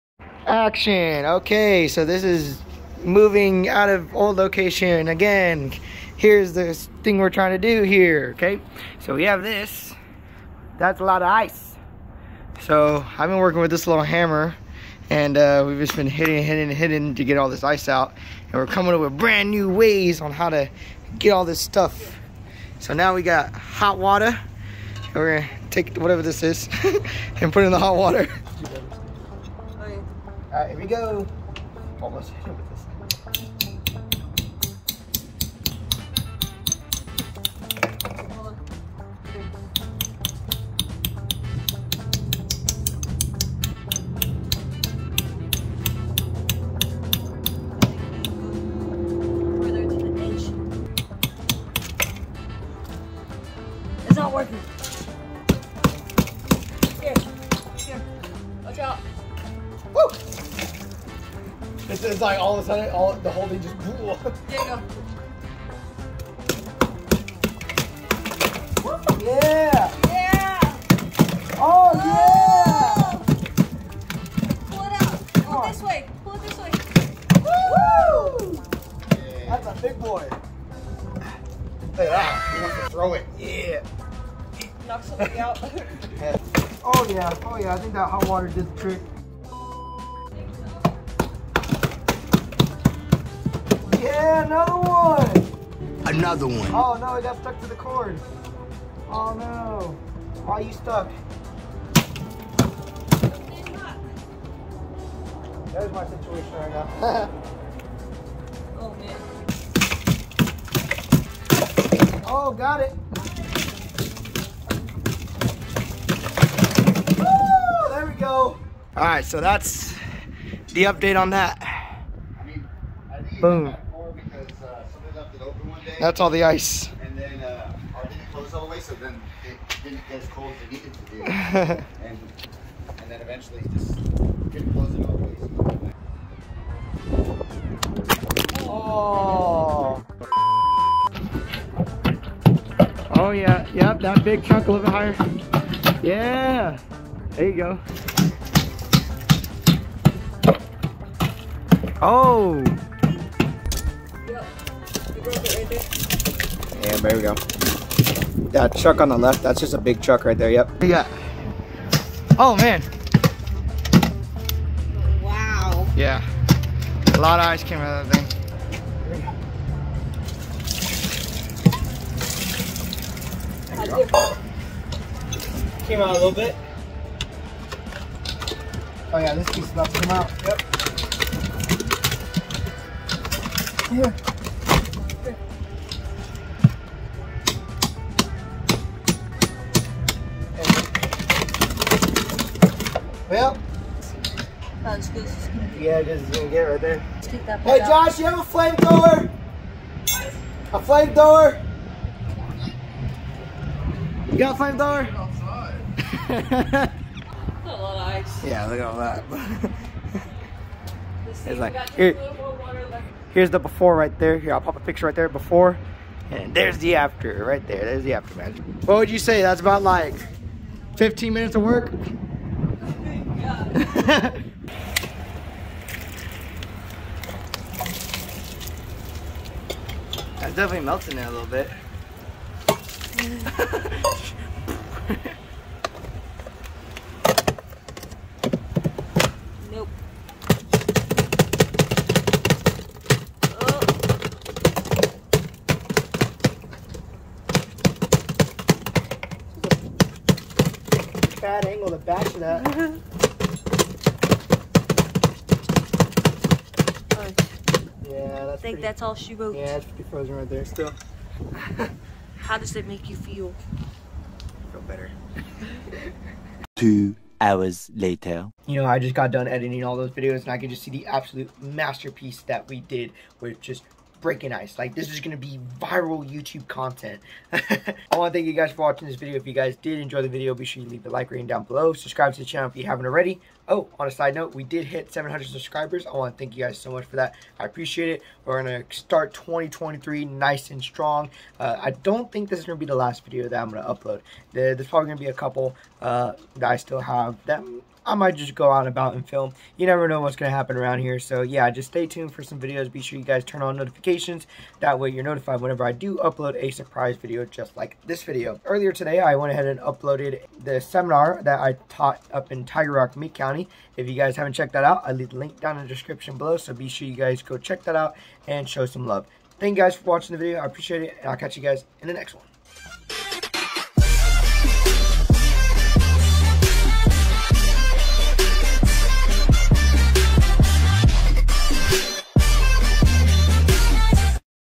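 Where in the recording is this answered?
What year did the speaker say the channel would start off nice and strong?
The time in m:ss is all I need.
4:49.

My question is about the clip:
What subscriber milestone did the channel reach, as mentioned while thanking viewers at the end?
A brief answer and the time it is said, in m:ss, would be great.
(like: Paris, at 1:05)
700, at 4:45.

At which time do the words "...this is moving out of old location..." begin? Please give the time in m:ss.
0:02.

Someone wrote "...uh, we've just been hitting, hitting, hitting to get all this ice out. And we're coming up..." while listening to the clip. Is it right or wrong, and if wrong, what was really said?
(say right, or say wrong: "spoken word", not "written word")
right.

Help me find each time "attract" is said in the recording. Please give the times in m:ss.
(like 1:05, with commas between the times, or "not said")
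not said.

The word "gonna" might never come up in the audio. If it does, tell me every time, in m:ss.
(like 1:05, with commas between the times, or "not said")
0:25, 3:16.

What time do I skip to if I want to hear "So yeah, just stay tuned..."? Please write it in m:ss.
5:01.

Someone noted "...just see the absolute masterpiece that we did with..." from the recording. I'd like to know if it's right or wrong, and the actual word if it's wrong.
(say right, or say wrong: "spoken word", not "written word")
right.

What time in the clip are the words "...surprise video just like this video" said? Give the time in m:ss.
5:06.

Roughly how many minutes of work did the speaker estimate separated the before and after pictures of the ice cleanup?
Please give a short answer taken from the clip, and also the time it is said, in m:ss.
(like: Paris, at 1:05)
15, at 3:40.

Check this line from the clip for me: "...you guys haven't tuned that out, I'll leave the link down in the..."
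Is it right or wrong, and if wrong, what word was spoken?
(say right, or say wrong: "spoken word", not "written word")
wrong: "checked", not "tuned".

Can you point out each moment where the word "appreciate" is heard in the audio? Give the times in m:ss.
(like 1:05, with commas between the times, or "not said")
4:47, 5:20.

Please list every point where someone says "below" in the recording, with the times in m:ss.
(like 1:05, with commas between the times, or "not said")
4:41, 5:16.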